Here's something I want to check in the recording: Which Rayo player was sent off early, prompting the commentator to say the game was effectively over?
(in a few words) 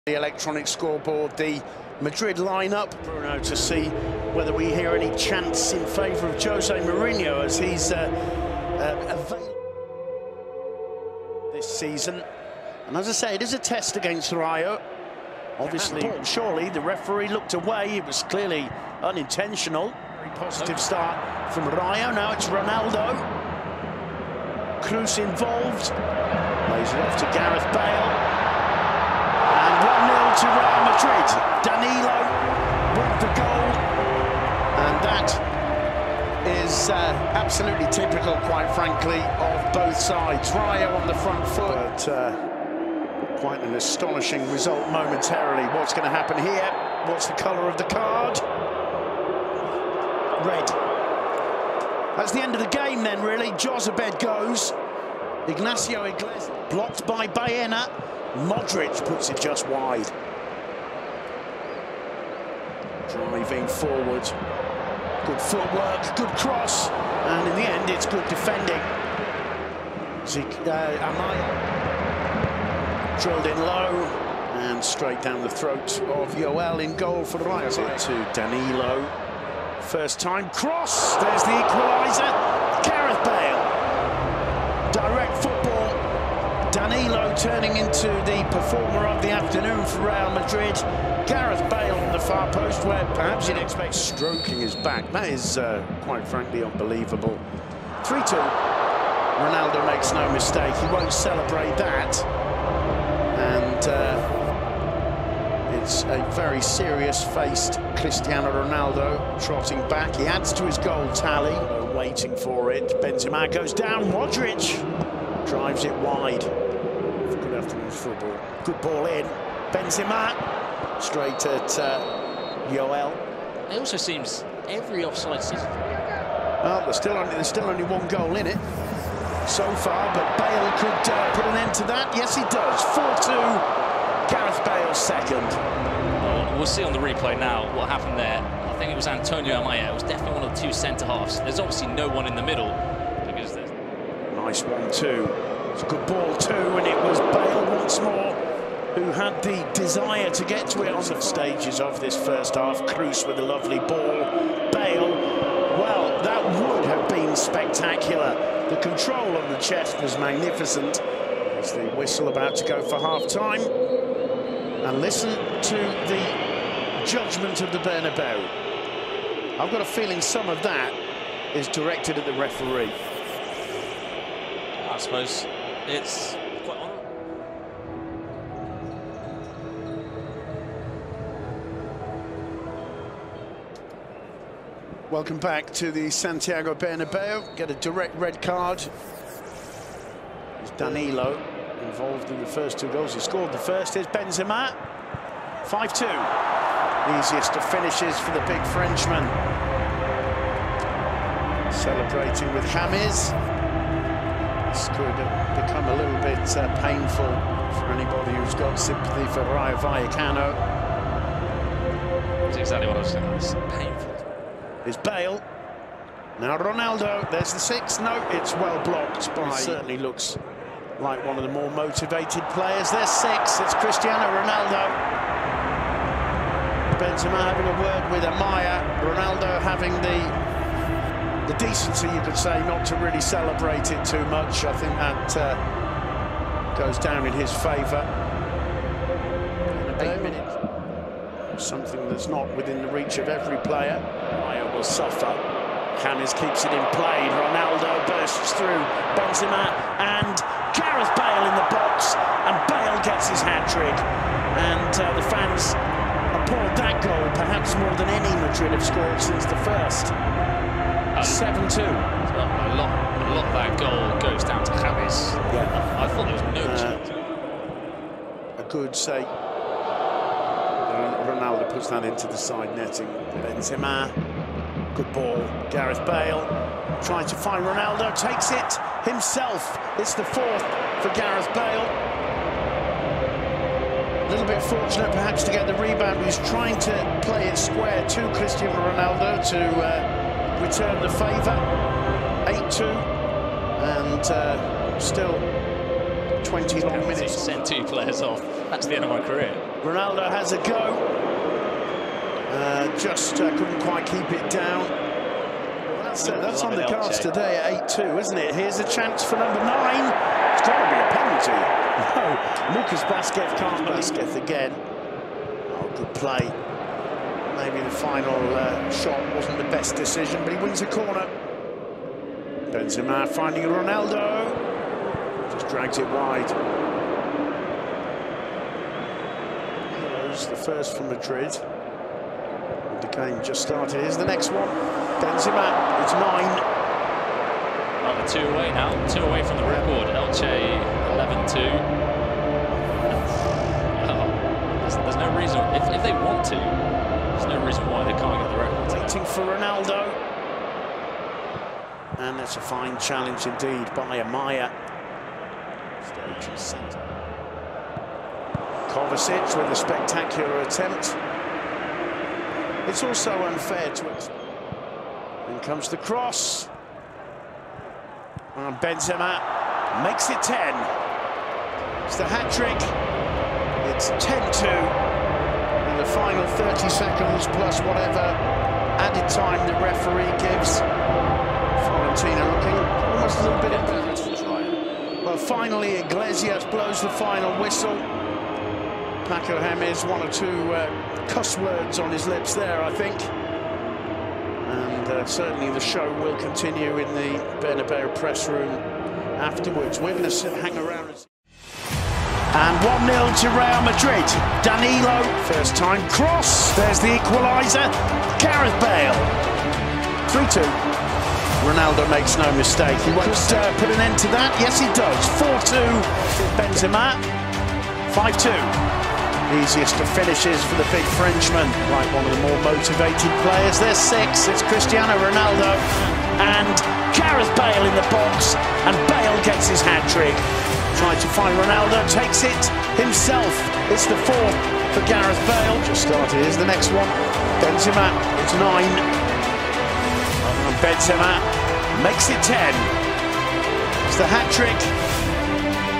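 Jozabed.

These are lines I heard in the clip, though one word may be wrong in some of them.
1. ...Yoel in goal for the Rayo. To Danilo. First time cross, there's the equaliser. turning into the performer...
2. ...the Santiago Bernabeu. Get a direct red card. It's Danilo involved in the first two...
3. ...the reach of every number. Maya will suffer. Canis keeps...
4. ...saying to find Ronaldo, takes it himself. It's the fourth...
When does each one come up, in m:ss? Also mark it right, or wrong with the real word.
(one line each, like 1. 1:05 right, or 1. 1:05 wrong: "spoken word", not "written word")
1. 1:16 right
2. 3:05 right
3. 4:02 wrong: "player", not "number"
4. 4:37 wrong: "trying", not "saying".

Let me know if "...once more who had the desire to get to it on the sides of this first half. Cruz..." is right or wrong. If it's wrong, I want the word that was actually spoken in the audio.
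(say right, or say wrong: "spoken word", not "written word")
wrong: "stages", not "sides".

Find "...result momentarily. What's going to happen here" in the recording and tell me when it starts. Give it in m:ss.
0:44.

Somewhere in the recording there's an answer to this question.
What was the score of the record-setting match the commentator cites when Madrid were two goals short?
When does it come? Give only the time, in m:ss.
5:41.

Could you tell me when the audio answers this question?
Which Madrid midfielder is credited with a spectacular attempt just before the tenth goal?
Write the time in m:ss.
5:58.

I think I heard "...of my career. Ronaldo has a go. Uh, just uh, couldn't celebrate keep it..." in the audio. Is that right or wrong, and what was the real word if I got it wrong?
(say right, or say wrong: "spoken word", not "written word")
wrong: "quite", not "celebrate".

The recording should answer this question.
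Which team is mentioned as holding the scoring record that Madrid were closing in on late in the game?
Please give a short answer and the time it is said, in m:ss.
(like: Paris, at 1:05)
Elche, at 5:40.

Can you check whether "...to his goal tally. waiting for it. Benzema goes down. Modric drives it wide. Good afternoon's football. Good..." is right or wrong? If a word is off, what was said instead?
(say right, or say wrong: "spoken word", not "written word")
right.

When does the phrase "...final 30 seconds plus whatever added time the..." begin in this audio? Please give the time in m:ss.
6:16.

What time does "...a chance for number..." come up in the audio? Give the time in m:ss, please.
5:08.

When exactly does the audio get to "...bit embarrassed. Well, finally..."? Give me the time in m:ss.
6:23.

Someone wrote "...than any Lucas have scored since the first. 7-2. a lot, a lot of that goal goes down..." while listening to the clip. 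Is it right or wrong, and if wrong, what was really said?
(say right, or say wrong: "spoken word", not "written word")
wrong: "Madrid", not "Lucas".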